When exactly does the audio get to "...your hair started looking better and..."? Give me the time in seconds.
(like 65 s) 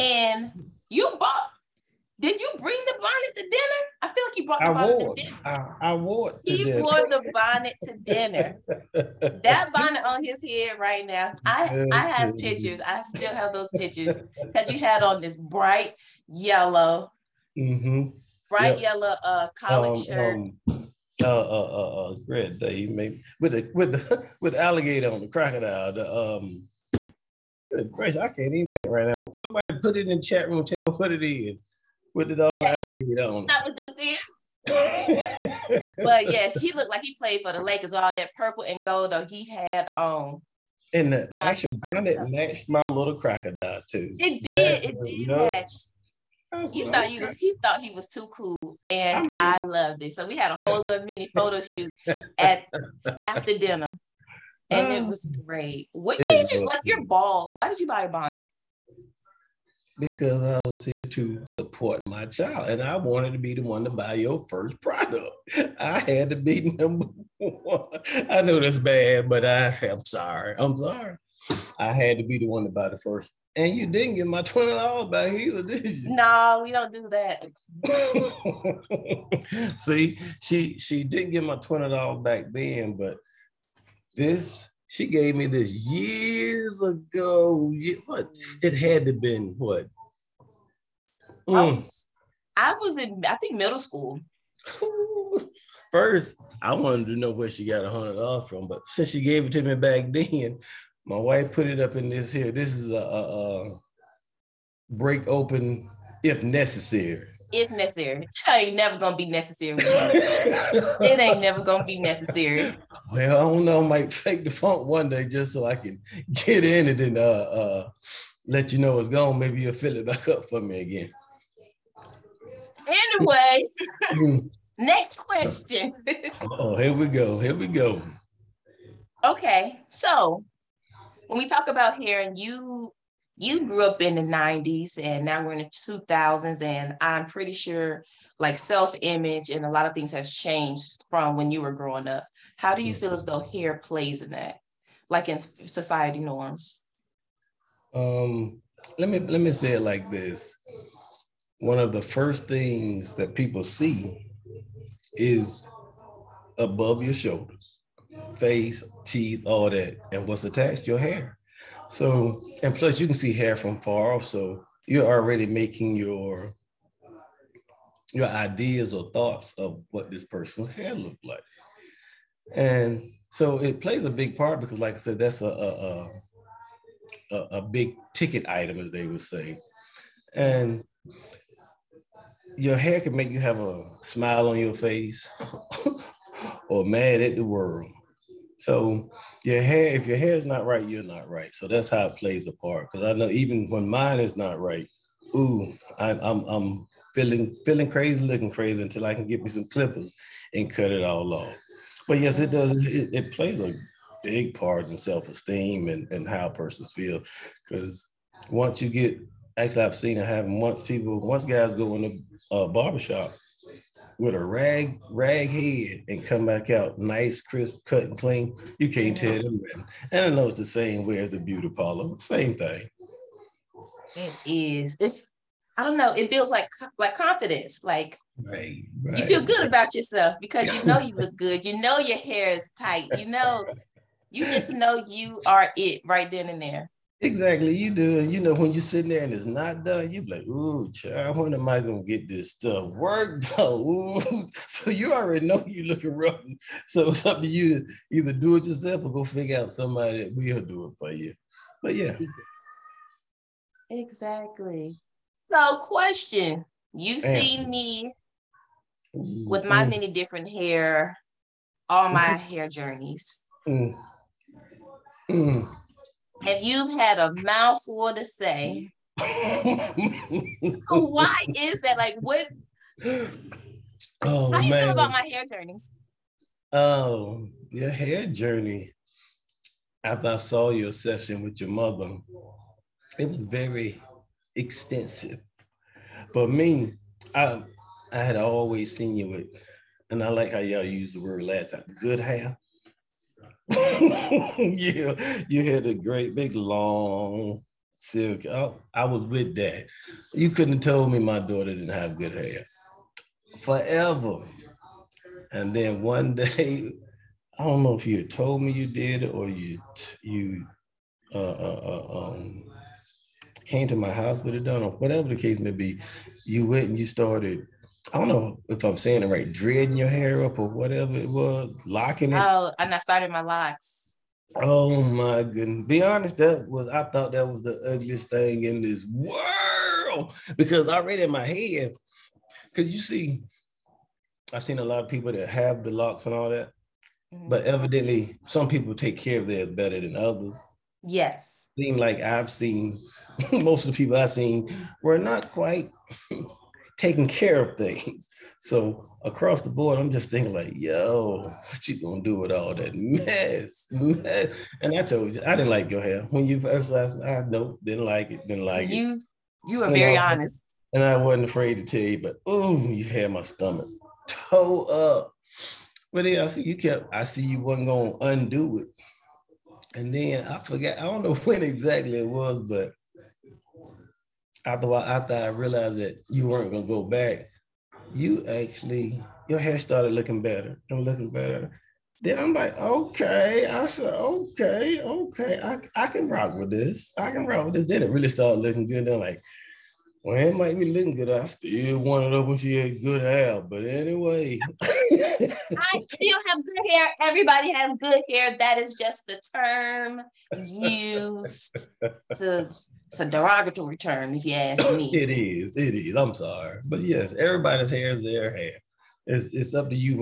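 379 s.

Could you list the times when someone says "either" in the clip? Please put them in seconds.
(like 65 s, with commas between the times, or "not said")
75 s, 248 s.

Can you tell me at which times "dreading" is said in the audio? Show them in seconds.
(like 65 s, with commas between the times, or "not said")
319 s.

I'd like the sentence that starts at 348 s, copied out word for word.
So across the board, I'm just thinking like, yo, what you gonna do with all that mess?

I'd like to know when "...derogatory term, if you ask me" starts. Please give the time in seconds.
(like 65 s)
403 s.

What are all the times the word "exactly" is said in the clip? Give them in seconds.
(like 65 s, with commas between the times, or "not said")
237 s, 253 s, 371 s.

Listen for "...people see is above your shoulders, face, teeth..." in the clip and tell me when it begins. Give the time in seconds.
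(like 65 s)
153 s.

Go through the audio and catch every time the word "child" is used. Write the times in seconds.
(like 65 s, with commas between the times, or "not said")
62 s, 240 s.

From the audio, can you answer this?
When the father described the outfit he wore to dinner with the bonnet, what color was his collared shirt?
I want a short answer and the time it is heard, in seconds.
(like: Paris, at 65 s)
bright yellow, at 15 s.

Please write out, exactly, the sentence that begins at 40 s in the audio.
Um, and the actual bonnet matched my little crocodile too.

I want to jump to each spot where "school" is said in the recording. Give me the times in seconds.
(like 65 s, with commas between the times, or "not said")
93 s.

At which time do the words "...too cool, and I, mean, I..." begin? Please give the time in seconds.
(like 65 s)
48 s.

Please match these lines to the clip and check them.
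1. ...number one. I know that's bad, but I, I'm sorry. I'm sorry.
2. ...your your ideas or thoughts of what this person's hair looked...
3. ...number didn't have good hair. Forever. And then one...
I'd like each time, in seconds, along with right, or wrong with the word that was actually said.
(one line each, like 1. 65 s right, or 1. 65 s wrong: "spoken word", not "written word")
1. 66 s right
2. 165 s right
3. 301 s wrong: "daughter", not "number".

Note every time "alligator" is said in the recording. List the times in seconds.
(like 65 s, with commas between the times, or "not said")
24 s, 32 s.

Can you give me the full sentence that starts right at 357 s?
I nope, didn't like it, didn't like you, it.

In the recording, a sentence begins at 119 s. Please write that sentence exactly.
Maybe you'll fill it back up for me again.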